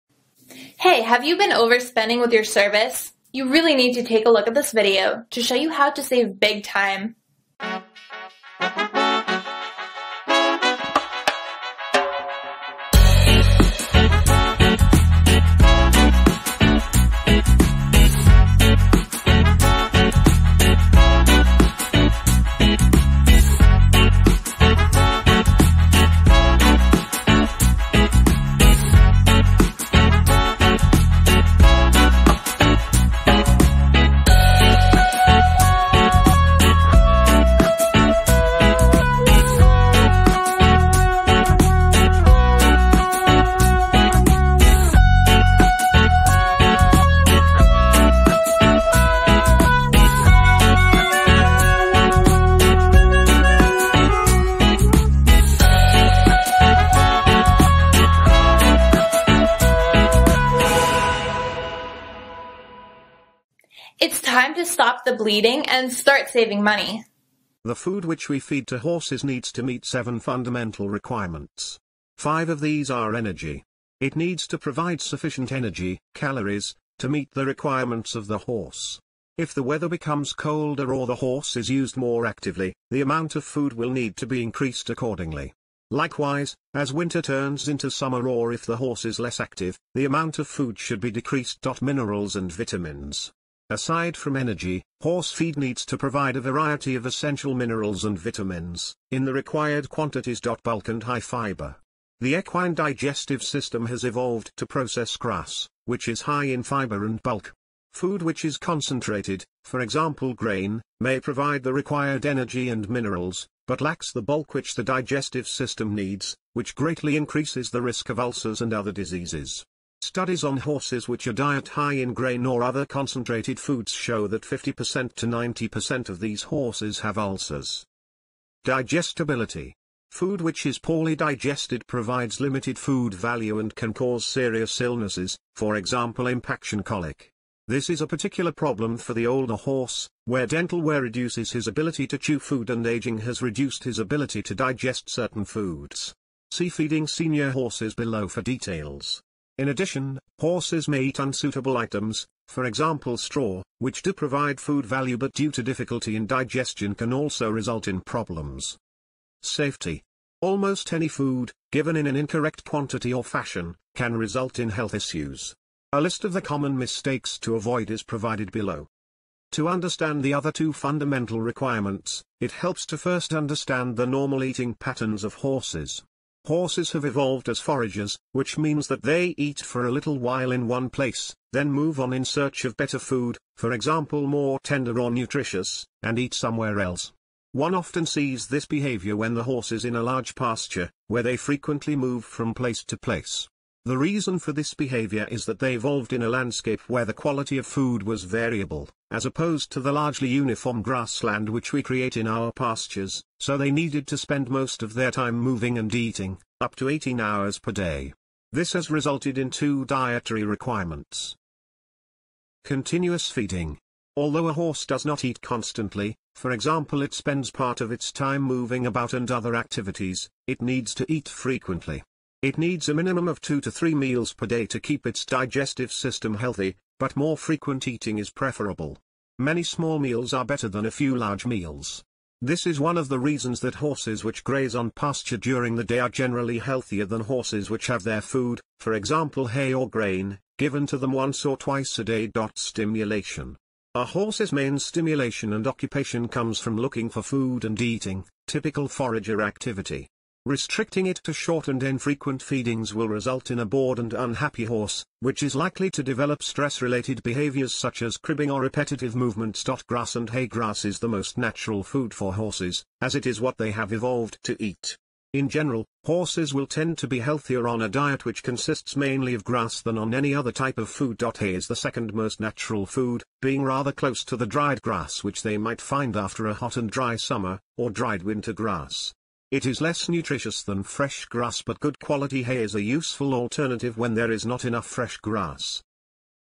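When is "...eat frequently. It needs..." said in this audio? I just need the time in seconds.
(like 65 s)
221 s.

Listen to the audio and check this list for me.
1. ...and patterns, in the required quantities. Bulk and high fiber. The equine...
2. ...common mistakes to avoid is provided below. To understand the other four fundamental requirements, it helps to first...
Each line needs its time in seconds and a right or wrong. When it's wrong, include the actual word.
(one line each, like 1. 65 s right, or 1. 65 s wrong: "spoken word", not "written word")
1. 98 s wrong: "vitamins", not "patterns"
2. 166 s wrong: "two", not "four".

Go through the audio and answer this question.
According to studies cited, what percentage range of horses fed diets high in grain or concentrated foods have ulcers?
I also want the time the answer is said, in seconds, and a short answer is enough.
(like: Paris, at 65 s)
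50% to 90%, at 124 s.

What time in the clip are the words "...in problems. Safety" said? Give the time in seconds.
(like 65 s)
157 s.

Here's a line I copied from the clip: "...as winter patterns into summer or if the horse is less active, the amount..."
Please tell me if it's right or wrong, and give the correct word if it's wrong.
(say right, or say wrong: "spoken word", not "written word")
wrong: "turns", not "patterns".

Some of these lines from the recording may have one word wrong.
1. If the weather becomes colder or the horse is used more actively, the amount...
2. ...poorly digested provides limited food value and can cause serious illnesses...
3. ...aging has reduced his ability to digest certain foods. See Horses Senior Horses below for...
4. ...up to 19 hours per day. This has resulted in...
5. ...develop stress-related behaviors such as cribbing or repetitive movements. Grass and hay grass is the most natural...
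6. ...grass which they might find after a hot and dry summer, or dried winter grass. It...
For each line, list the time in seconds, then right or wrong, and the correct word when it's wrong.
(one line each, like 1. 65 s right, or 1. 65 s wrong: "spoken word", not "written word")
1. 79 s right
2. 130 s right
3. 142 s wrong: "Feeding", not "Horses"
4. 206 s wrong: "18", not "19"
5. 256 s right
6. 274 s right.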